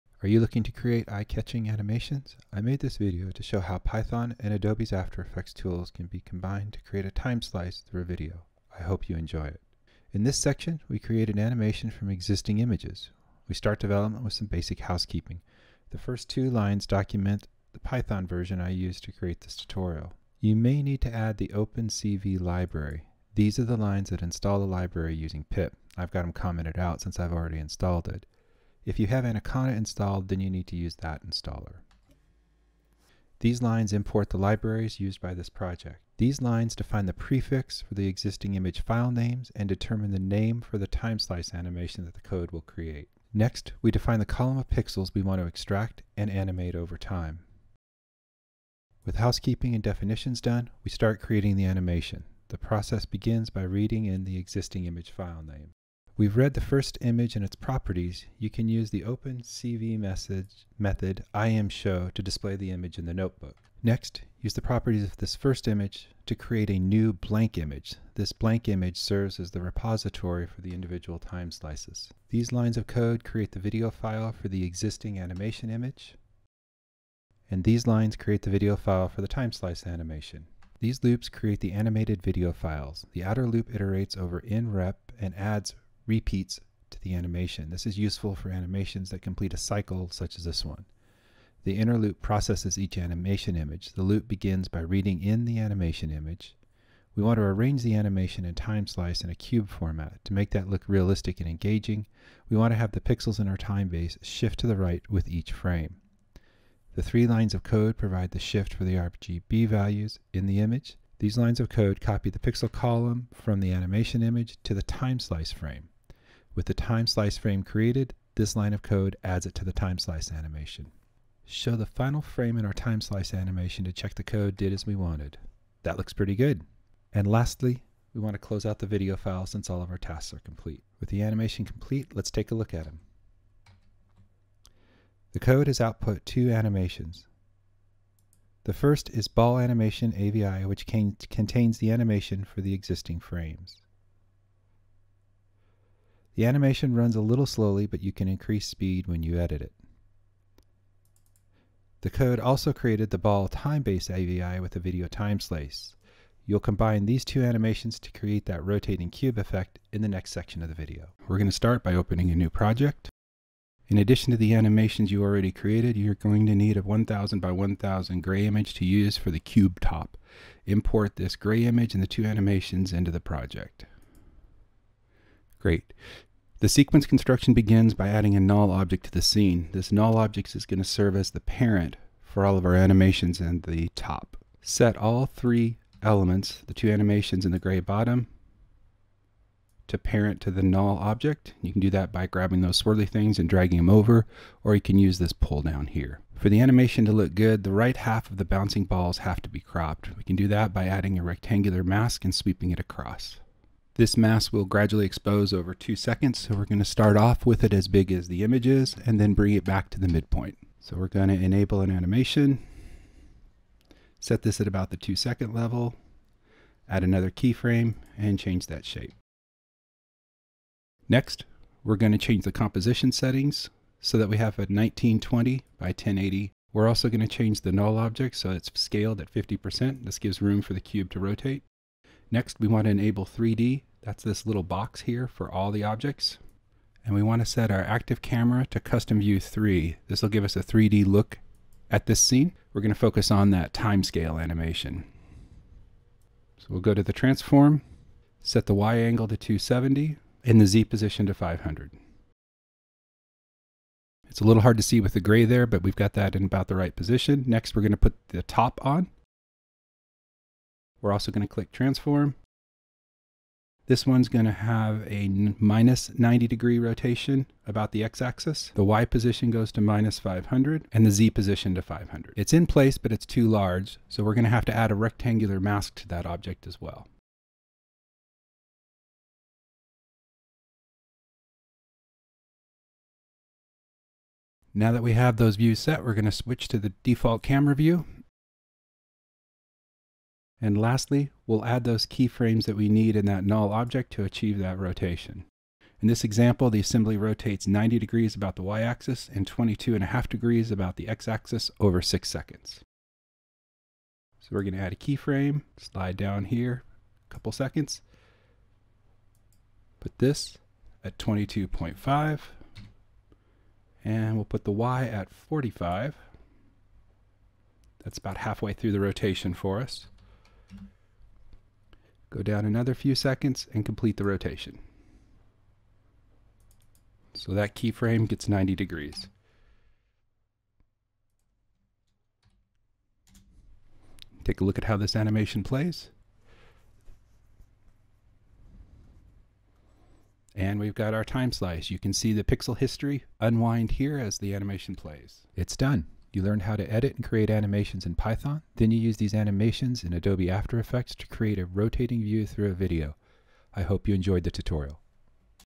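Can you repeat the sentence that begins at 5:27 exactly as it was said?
So that keyframe gets 90 degrees.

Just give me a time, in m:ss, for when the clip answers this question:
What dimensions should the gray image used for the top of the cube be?
2:46.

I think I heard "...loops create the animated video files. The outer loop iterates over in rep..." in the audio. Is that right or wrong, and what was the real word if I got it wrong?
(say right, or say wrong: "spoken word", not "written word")
right.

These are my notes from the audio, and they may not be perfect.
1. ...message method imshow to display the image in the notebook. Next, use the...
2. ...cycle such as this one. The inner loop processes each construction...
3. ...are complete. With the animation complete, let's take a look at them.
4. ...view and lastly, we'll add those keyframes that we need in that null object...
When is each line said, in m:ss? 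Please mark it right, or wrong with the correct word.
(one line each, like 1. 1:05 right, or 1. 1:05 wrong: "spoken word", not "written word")
1. 0:59 right
2. 1:29 wrong: "animation", not "construction"
3. 2:10 right
4. 4:47 right.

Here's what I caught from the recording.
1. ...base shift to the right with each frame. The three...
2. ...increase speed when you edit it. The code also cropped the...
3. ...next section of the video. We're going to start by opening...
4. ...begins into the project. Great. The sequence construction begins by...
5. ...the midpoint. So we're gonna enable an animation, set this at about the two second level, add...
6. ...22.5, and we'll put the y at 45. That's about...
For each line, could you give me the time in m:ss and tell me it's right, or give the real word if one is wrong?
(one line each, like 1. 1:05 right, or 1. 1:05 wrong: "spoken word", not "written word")
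1. 1:43 right
2. 2:28 wrong: "created", not "cropped"
3. 2:40 right
4. 2:52 wrong: "animations", not "begins"
5. 3:29 right
6. 5:11 right.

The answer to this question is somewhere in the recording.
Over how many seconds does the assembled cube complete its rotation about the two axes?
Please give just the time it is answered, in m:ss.
5:02.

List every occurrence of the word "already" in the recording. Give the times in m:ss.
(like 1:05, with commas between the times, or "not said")
0:27, 2:45.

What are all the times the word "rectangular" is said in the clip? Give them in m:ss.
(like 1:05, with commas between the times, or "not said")
3:21, 4:34.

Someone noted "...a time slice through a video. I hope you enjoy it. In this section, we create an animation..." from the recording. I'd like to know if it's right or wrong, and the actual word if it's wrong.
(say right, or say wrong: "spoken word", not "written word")
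right.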